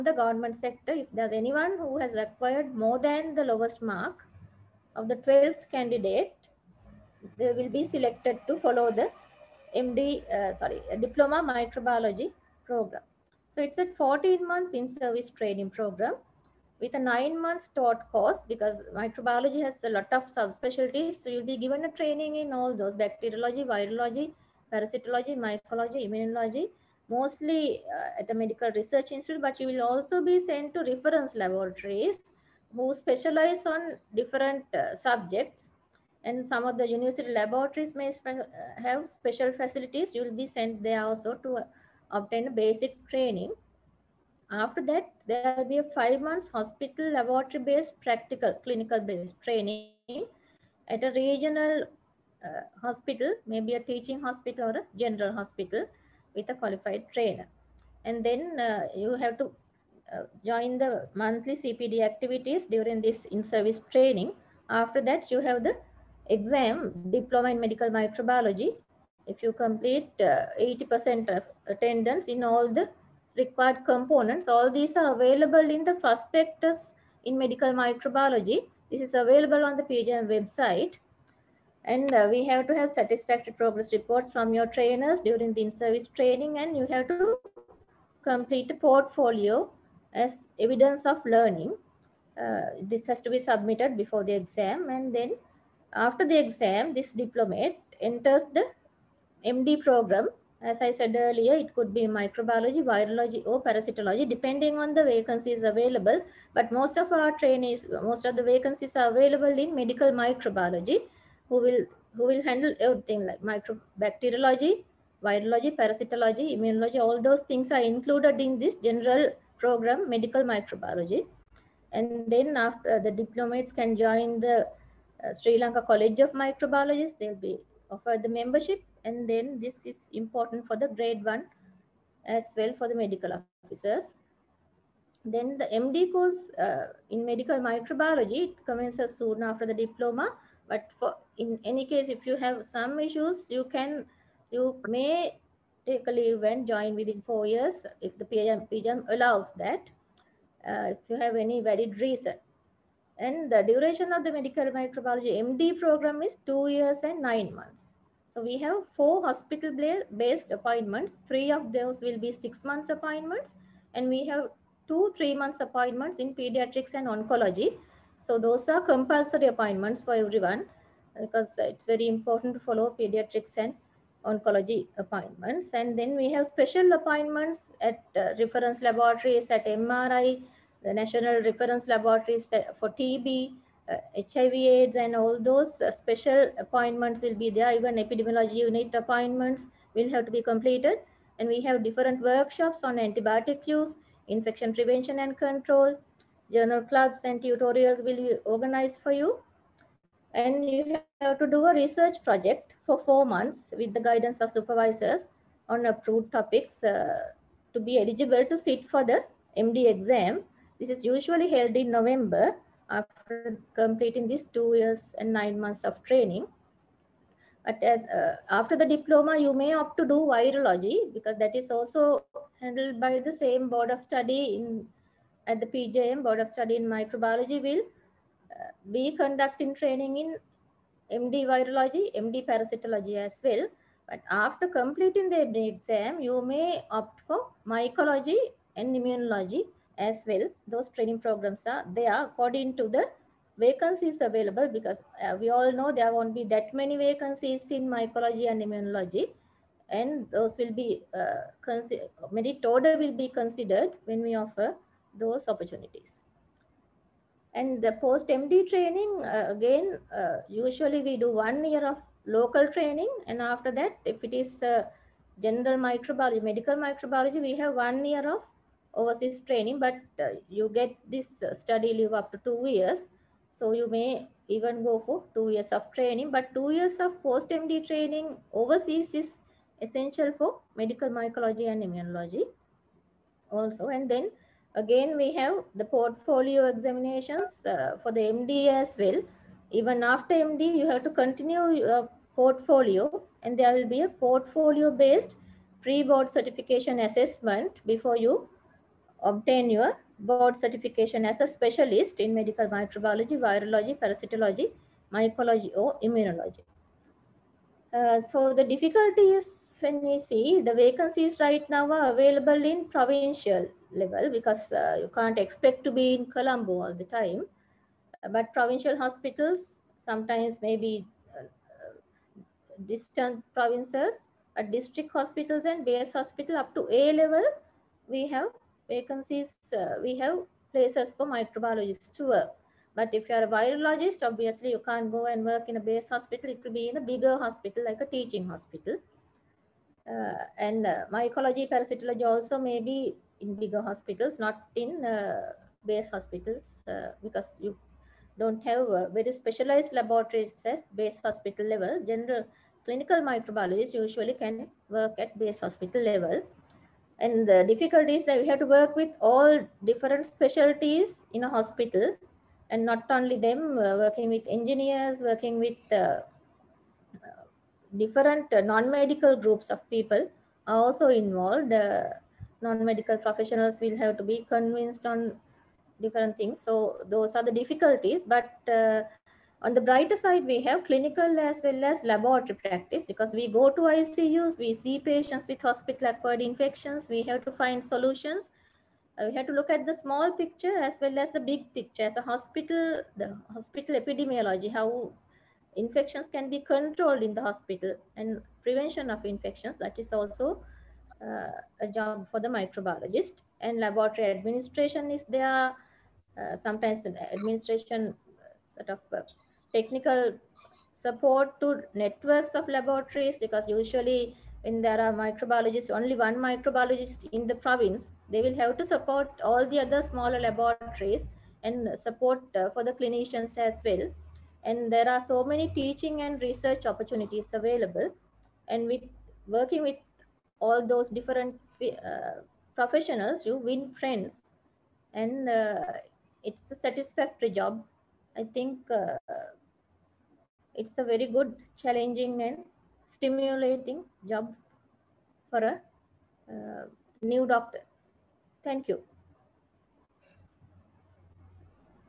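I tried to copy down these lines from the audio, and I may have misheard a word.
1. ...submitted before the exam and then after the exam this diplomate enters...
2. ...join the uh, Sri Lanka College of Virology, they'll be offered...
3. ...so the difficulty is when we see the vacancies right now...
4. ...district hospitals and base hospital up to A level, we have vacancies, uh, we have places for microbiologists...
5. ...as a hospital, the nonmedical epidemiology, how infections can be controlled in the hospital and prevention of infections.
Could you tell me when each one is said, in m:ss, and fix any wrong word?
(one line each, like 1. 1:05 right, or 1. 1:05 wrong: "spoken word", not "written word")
1. 1:33 right
2. 2:03 wrong: "Microbiologists", not "Virology"
3. 5:08 right
4. 5:24 right
5. 6:32 wrong: "hospital", not "nonmedical".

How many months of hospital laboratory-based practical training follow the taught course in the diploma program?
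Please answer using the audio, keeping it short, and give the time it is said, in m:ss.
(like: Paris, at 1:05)
5 months, at 0:45.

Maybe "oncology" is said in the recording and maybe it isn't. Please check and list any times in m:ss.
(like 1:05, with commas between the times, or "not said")
2:47, 2:54.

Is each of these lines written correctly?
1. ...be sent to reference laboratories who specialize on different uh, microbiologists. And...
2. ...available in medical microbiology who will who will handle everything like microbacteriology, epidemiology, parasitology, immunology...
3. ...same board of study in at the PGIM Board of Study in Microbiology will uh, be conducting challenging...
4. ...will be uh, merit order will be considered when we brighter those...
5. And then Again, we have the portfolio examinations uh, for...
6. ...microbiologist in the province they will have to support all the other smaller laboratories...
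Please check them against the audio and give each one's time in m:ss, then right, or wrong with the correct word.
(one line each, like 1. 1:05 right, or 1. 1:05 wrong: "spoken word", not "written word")
1. 0:30 wrong: "subjects", not "microbiologists"
2. 1:49 wrong: "virology", not "epidemiology"
3. 3:43 wrong: "training", not "challenging"
4. 4:10 wrong: "offer", not "brighter"
5. 4:43 right
6. 6:56 right.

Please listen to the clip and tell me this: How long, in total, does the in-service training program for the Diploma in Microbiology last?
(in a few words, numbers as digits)
14 months.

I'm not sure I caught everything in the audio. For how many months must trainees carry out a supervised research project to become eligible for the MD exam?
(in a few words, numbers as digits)
4 months.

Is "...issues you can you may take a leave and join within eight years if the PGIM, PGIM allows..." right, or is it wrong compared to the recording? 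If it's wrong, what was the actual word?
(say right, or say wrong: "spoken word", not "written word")
wrong: "four", not "eight".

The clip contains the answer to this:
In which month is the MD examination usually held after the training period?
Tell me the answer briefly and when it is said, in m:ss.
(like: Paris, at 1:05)
November, at 3:31.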